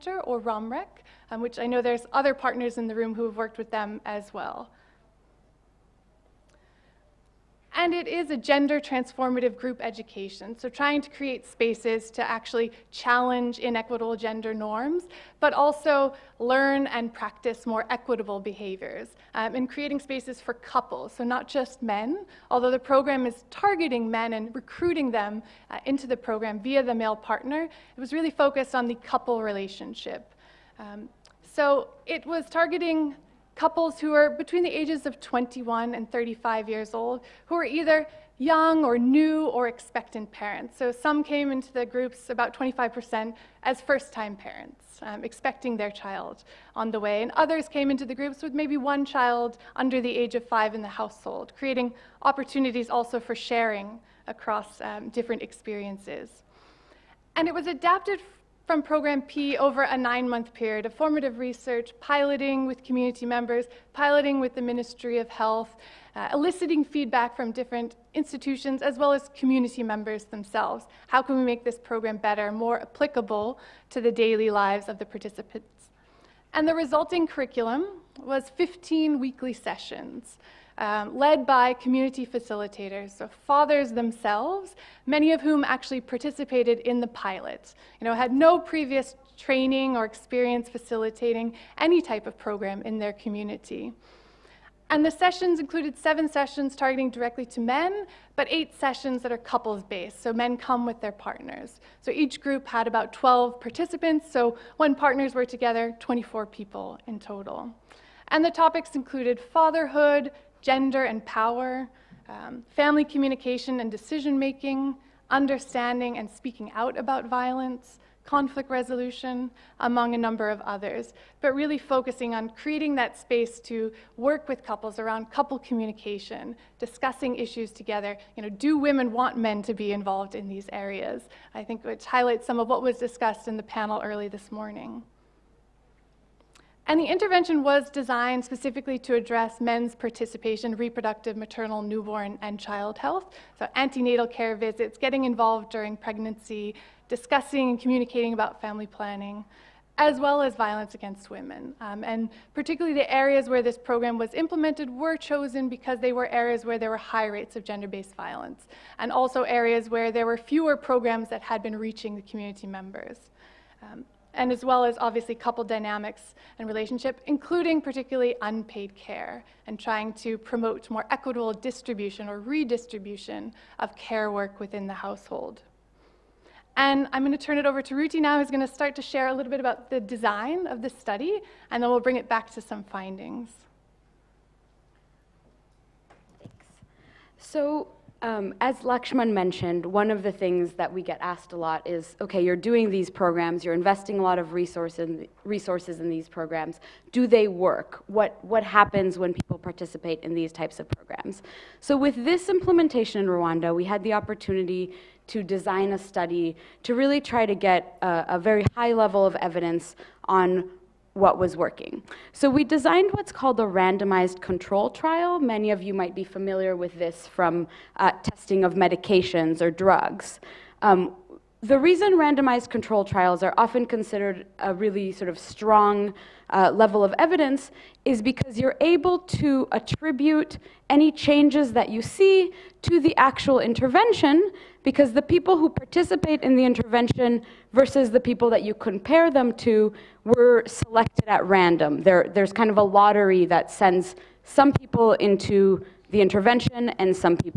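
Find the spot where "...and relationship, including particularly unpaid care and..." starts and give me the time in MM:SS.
02:46.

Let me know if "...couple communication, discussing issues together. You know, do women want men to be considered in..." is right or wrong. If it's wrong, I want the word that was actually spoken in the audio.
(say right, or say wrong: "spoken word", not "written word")
wrong: "involved", not "considered".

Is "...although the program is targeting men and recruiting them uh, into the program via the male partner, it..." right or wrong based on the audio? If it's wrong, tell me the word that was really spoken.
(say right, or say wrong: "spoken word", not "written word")
right.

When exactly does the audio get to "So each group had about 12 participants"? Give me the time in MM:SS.
01:42.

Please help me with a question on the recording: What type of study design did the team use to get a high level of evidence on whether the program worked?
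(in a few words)
Randomized control trial.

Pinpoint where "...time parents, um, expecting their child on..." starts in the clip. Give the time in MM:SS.
00:44.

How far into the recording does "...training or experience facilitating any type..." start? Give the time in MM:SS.
01:29.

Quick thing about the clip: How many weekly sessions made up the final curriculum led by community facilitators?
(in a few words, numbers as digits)
15.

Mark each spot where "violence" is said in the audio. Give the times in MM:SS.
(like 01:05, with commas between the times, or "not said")
01:57, 02:30, 02:38.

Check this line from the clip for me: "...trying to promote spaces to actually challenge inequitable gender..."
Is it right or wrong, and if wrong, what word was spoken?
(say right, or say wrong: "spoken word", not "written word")
wrong: "create", not "promote".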